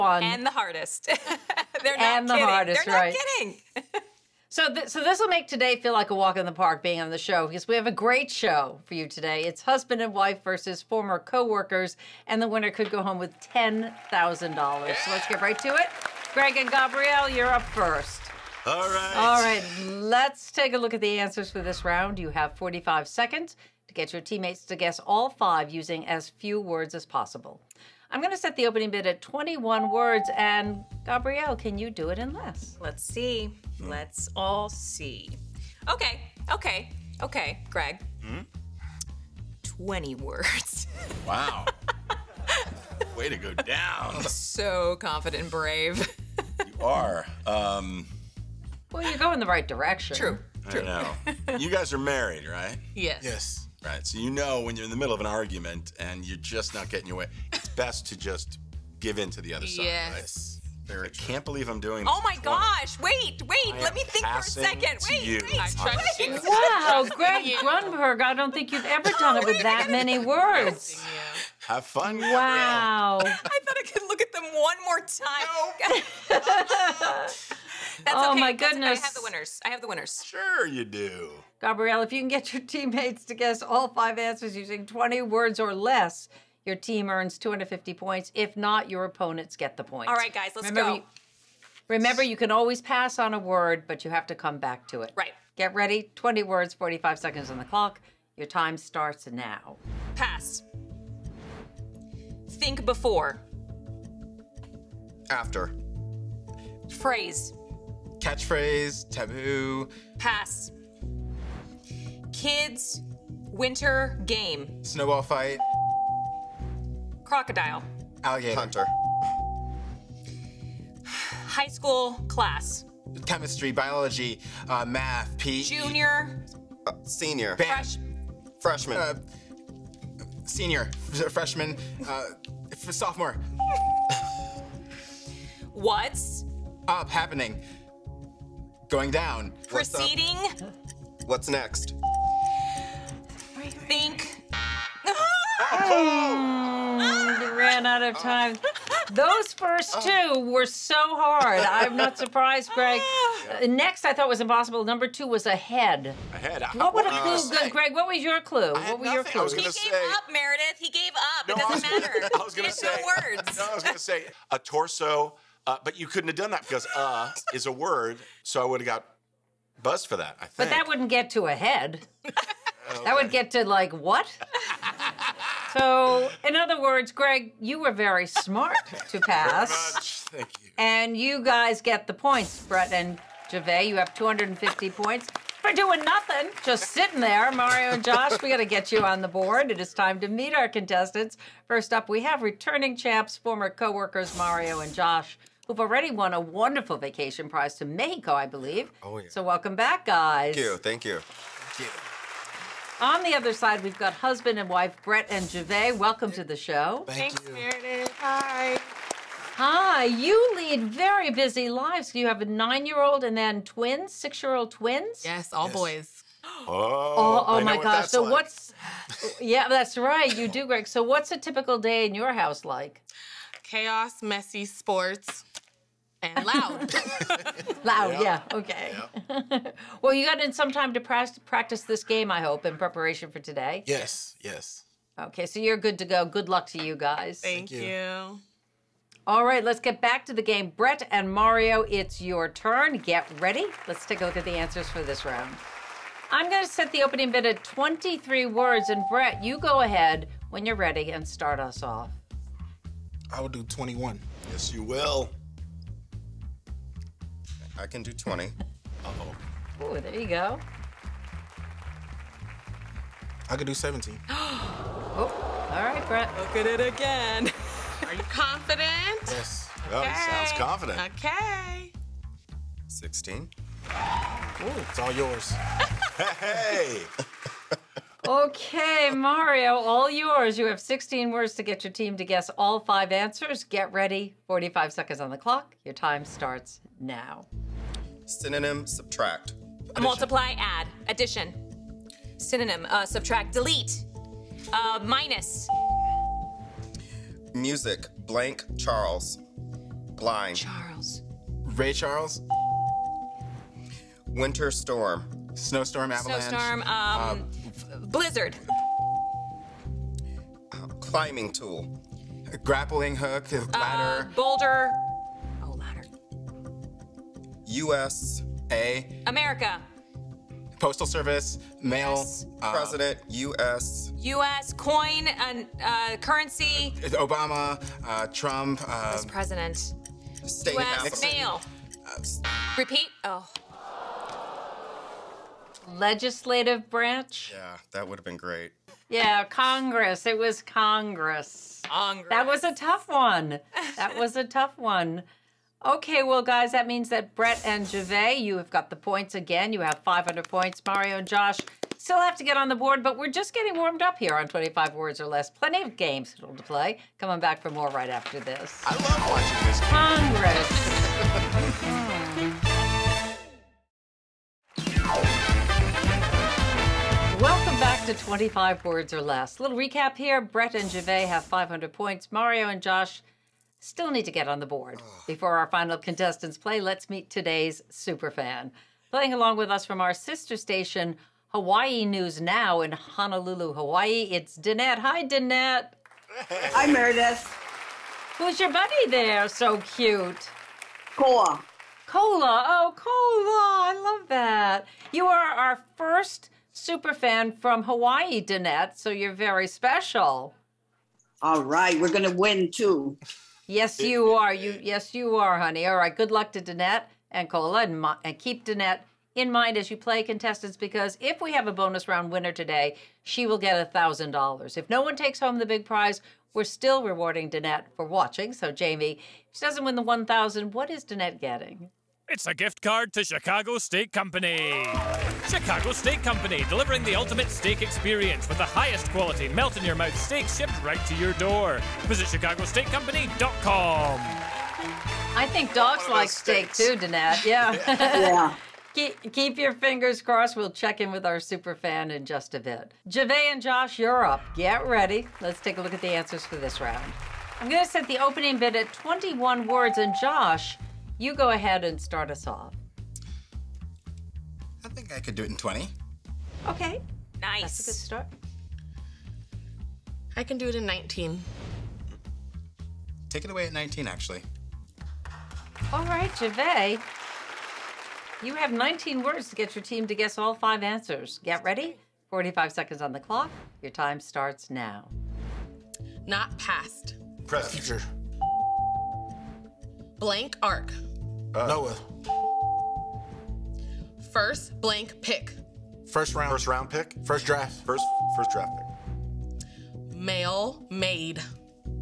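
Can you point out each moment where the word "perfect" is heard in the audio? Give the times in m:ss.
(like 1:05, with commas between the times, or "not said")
not said.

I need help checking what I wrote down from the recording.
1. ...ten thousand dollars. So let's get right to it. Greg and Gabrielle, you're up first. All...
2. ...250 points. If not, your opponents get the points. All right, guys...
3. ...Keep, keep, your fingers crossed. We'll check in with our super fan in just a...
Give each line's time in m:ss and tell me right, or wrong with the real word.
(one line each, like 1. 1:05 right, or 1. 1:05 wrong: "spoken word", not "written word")
1. 0:13 right
2. 1:27 right
3. 7:18 right.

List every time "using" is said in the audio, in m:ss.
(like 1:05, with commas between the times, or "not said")
0:25, 1:24.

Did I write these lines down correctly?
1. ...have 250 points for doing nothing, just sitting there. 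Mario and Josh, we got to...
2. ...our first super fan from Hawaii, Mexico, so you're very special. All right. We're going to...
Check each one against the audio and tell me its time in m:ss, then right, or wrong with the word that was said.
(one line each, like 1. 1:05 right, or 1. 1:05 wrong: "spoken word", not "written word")
1. 3:03 right
2. 6:35 wrong: "Danette", not "Mexico".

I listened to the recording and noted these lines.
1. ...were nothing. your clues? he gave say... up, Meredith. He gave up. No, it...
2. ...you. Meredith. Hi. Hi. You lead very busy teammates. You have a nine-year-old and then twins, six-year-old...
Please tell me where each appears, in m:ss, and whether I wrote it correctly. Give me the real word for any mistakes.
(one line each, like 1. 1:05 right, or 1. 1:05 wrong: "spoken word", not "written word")
1. 2:38 right
2. 3:27 wrong: "lives", not "teammates".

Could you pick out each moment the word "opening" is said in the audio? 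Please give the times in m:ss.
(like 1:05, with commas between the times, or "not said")
0:28, 4:07, 7:28.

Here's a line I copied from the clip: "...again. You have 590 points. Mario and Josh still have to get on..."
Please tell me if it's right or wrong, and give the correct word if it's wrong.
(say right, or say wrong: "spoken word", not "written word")
wrong: "500", not "590".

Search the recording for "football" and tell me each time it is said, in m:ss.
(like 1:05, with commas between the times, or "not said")
not said.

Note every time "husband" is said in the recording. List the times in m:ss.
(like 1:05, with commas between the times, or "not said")
0:09, 3:24.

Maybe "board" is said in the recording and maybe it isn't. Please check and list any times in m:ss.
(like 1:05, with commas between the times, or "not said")
3:09, 5:52, 6:14.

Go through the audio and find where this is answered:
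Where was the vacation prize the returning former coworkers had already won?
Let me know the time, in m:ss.
3:17.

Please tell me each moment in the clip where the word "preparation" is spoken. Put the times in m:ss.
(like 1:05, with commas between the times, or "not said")
3:52.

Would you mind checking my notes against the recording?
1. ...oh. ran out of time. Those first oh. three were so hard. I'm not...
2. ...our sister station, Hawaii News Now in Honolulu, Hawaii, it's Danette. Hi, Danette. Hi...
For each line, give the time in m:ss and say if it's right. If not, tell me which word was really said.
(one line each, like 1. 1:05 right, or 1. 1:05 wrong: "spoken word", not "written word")
1. 2:25 wrong: "two", not "three"
2. 6:19 right.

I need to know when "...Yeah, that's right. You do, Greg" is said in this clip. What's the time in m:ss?
3:39.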